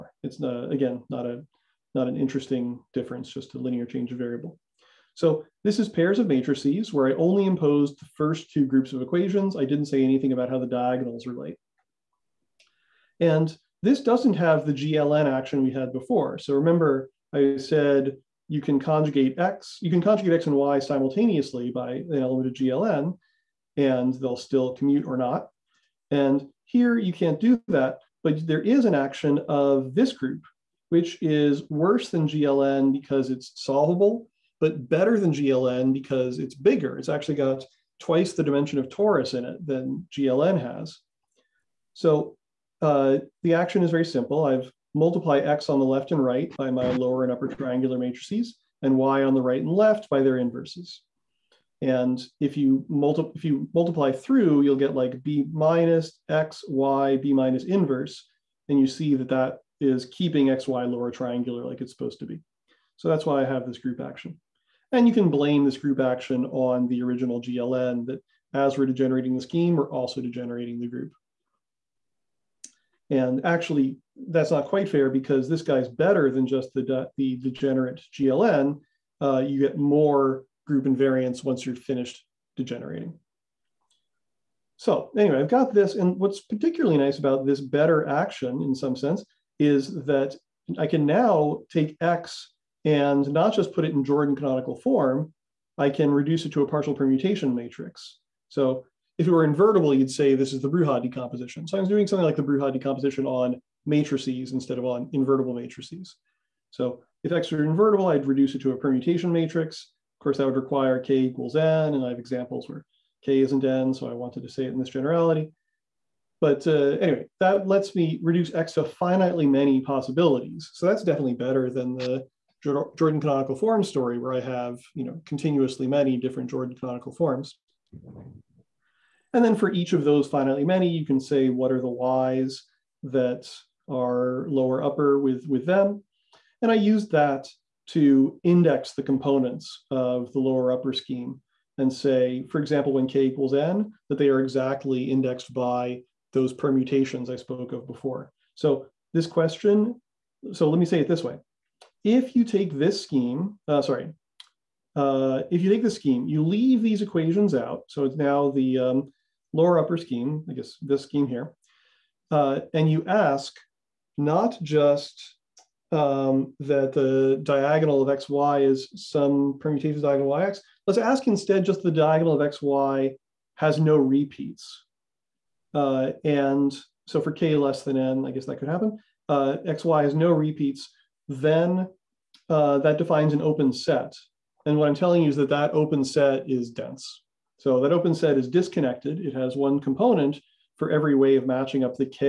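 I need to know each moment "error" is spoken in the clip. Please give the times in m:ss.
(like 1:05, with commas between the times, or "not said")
not said.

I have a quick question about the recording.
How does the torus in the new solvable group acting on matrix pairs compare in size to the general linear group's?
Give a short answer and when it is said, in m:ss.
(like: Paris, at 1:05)
Twice the dimension, at 0:37.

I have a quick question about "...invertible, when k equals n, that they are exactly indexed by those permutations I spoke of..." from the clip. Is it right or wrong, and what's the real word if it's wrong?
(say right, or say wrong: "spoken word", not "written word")
wrong: "example", not "invertible".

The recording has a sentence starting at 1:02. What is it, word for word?
So that's why I have this group action.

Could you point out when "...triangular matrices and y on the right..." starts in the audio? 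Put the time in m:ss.
0:47.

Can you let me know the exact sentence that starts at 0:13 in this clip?
And this doesn't have the GLN action we had before.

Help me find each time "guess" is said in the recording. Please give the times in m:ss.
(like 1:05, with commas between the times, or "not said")
2:40, 2:58.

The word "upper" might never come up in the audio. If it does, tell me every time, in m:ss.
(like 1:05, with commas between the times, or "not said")
0:47, 2:14, 2:20, 2:39.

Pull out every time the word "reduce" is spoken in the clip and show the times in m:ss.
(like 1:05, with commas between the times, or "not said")
1:36, 1:48, 1:58.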